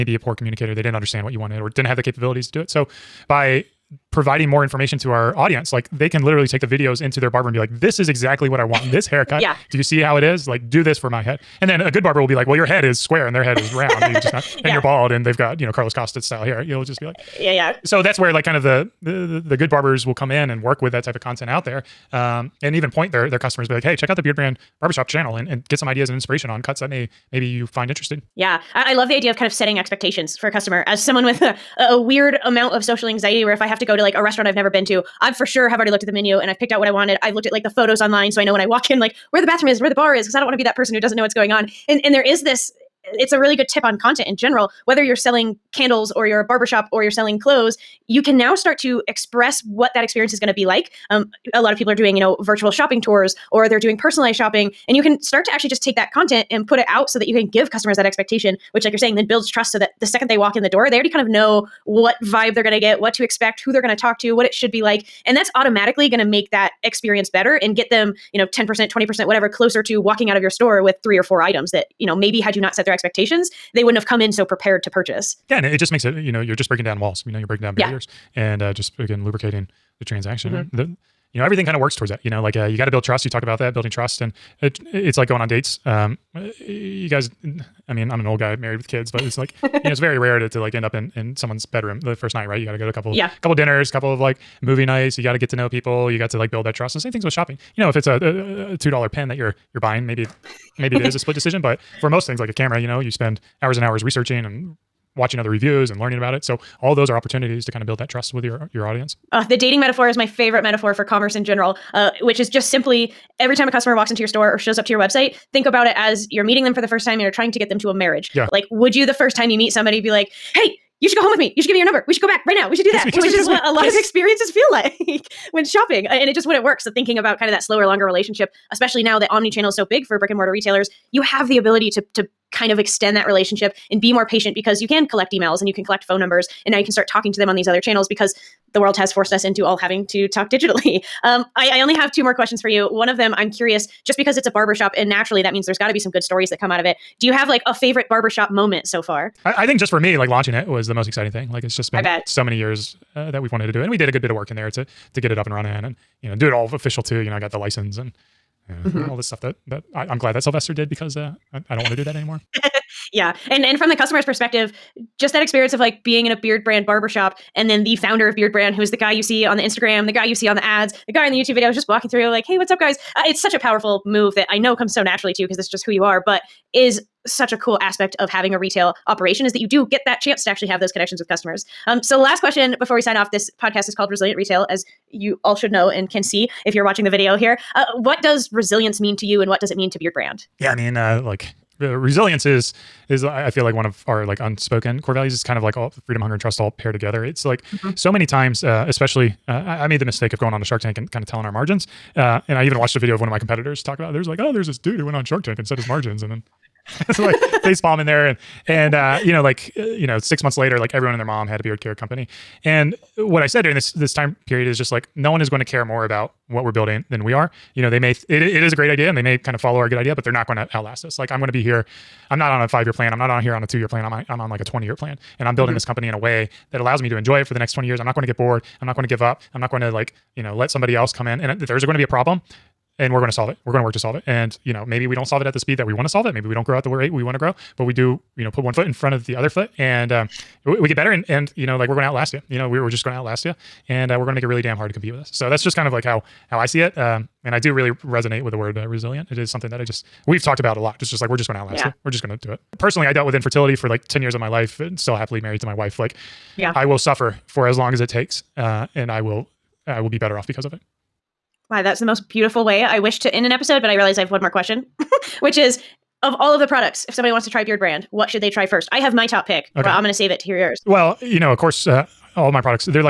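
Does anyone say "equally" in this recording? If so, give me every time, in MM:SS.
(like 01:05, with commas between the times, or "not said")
not said.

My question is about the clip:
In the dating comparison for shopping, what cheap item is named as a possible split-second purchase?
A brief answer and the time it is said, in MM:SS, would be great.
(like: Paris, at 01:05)
$2 pen, at 01:38.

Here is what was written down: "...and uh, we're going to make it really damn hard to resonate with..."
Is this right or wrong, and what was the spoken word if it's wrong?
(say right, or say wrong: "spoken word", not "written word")
wrong: "compete", not "resonate".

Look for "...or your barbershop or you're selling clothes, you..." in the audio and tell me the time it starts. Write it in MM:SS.
00:46.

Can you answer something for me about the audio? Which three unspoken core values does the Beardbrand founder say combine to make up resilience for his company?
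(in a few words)
Freedom, hunger, and trust.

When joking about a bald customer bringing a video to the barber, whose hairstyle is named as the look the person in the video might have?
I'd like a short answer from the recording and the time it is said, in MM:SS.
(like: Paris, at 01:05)
Carlos Costa, at 00:15.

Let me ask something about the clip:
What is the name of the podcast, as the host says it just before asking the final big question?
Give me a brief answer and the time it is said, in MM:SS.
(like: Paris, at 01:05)
Resilient Retail, at 03:04.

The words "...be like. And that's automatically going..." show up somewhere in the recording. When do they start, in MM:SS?
01:04.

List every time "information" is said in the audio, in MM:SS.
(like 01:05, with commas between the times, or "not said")
00:04.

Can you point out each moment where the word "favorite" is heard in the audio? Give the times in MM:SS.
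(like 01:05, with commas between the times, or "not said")
01:50, 02:27.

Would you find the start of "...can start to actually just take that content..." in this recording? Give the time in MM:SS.
00:55.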